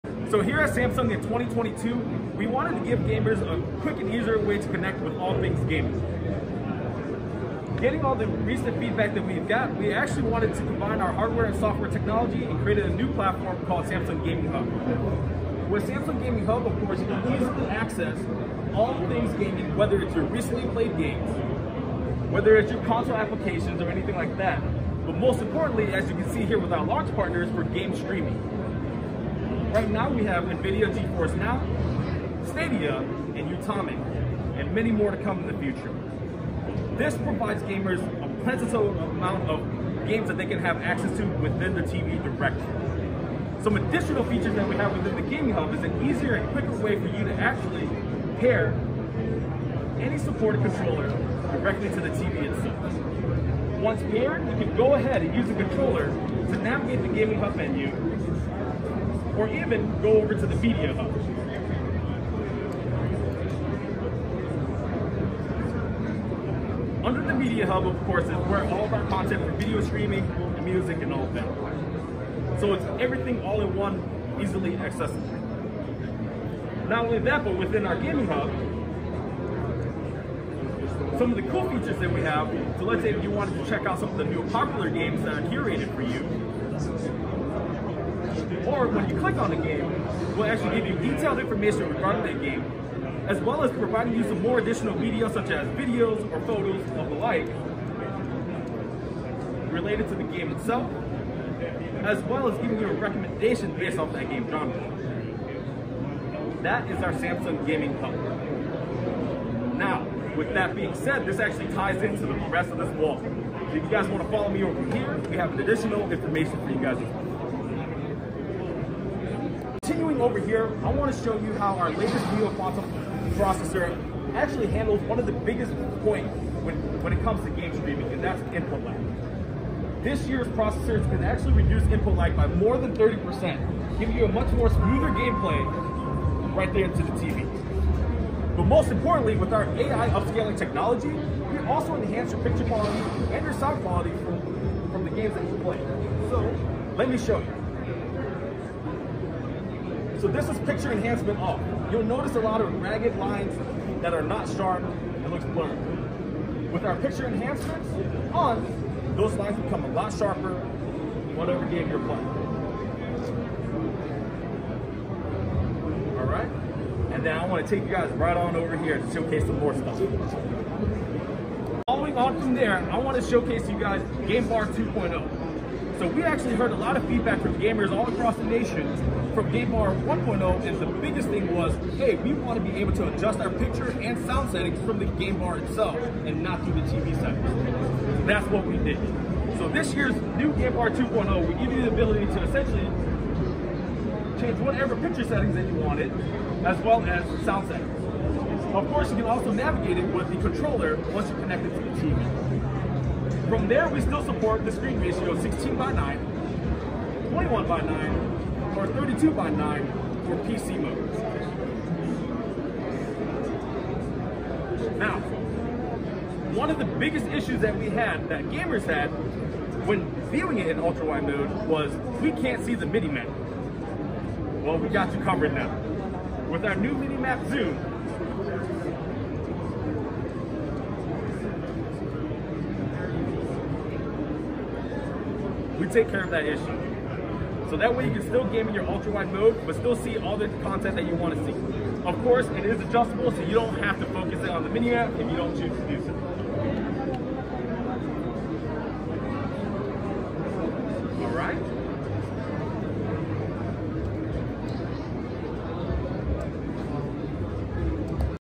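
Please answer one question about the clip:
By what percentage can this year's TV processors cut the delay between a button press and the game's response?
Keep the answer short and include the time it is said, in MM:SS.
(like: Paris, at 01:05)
30%, at 02:12.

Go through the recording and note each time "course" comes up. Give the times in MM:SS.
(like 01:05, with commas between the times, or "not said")
00:16, 01:08, 03:18, 04:02.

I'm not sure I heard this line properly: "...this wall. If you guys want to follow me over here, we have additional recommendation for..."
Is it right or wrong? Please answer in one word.
wrong.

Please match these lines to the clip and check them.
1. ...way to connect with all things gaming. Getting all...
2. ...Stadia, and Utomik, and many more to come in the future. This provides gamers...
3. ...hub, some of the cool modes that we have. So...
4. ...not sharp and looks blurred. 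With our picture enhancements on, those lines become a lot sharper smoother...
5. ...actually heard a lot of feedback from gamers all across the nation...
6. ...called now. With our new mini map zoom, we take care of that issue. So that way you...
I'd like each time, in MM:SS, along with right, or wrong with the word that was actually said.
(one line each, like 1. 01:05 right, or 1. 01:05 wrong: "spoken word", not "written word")
1. 00:04 right
2. 00:32 right
3. 01:18 wrong: "features", not "modes"
4. 02:34 wrong: "whatever", not "smoother"
5. 02:56 right
6. 03:45 wrong: "covered", not "called".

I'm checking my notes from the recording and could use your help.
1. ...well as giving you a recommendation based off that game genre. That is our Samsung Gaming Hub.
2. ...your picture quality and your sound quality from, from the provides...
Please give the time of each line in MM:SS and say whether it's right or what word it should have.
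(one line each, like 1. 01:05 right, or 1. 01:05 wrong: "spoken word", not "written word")
1. 01:42 right
2. 02:22 wrong: "games", not "provides".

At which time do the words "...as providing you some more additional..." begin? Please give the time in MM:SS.
01:33.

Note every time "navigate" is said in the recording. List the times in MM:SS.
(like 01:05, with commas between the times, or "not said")
00:56, 03:19.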